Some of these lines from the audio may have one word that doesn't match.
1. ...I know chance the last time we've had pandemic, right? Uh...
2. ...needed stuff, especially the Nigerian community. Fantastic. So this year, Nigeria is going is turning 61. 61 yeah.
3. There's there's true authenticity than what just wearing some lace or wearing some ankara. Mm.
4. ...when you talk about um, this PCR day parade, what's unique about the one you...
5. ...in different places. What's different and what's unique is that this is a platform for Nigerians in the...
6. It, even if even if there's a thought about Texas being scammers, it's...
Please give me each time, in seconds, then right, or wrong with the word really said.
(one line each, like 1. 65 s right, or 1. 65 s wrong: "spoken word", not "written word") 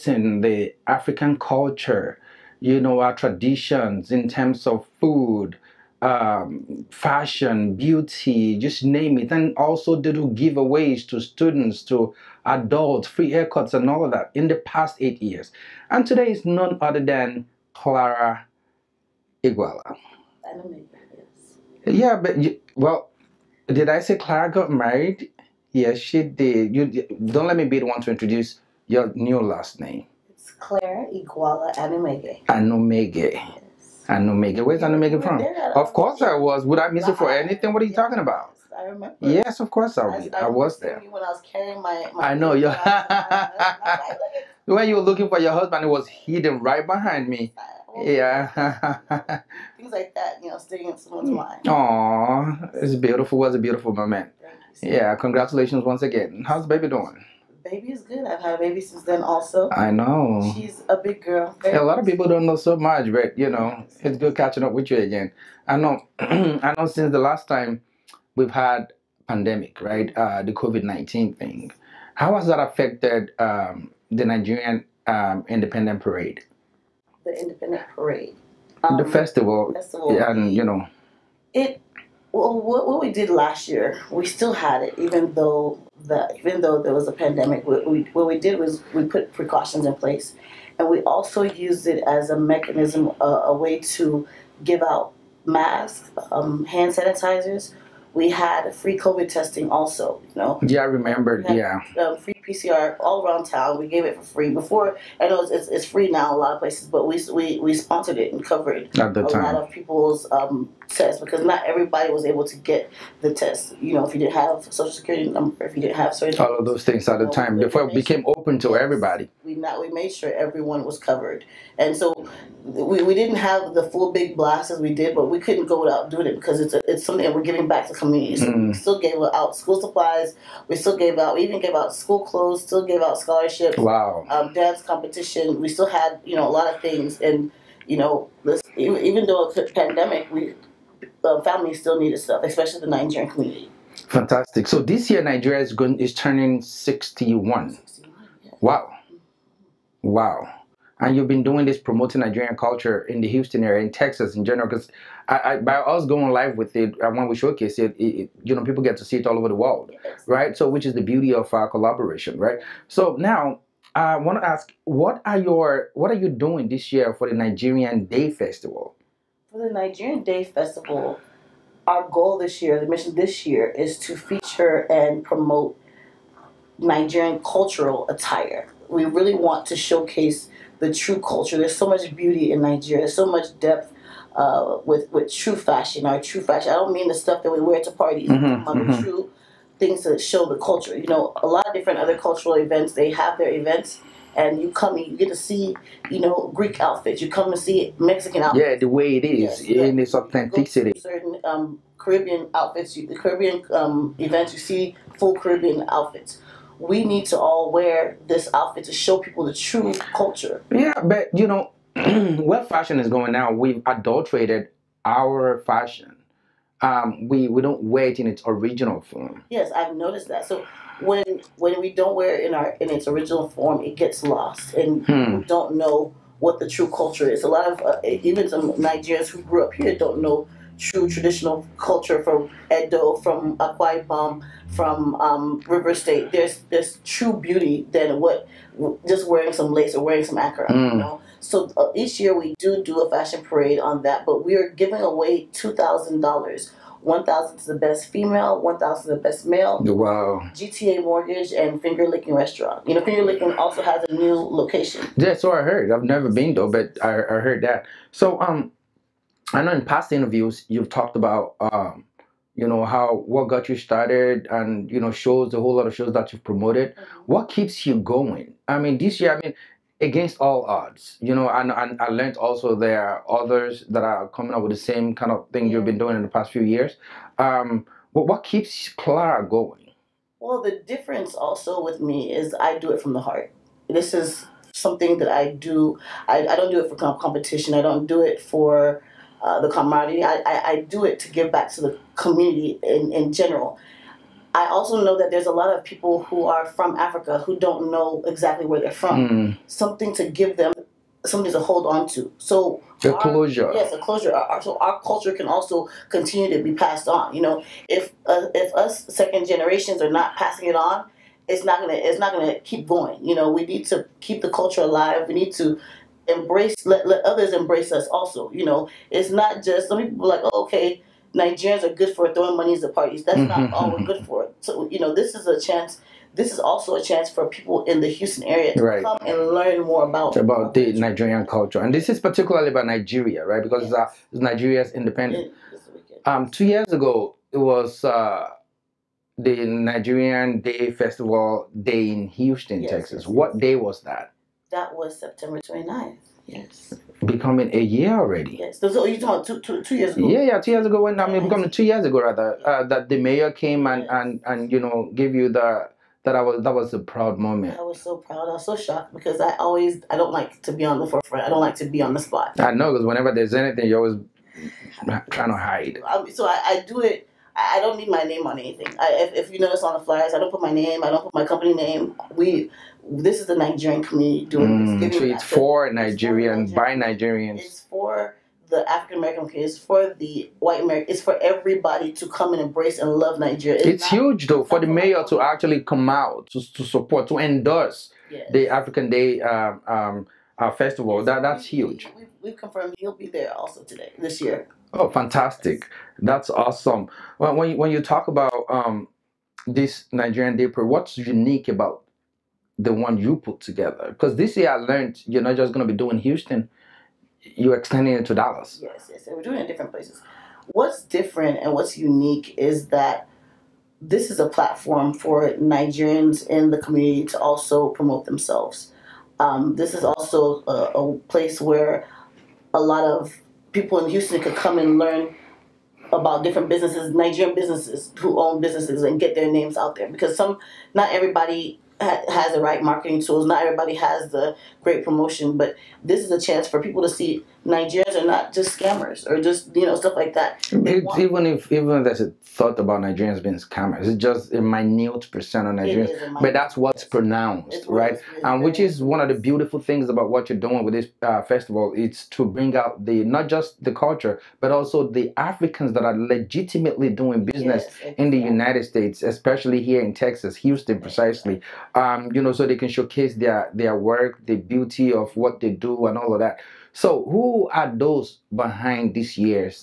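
1. 66 s wrong: "since", not "chance"
2. 141 s right
3. 236 s wrong: "beauty", not "authenticity"
4. 397 s wrong: "Nigerian", not "PCR"
5. 409 s right
6. 440 s wrong: "Nigerians", not "Texas".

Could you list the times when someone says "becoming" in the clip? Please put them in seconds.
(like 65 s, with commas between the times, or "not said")
347 s, 351 s.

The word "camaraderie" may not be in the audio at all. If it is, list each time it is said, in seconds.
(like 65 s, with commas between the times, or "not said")
289 s.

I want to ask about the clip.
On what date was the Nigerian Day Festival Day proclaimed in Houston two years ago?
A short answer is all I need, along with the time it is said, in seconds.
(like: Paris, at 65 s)
September 29, at 345 s.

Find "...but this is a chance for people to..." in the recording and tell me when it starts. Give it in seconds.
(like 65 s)
435 s.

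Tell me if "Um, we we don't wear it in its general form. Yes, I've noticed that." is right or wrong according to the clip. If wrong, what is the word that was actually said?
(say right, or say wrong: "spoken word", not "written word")
wrong: "original", not "general".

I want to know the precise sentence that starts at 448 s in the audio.
and which is one of the beautiful things about what you're doing with this uh, festival.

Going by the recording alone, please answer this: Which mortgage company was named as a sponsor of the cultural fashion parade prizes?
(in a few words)
GTA Mortgage.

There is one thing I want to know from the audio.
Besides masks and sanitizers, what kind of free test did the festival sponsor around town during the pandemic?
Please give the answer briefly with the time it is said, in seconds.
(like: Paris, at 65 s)
PCR, at 102 s.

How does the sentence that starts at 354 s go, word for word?
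and and you know gave you the that I was that was a proud moment.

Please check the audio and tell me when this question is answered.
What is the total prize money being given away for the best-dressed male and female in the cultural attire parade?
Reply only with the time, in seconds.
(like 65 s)
245 s.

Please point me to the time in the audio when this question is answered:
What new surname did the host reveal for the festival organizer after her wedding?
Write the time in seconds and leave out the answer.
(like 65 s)
30 s.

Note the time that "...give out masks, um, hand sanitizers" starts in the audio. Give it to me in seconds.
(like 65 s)
94 s.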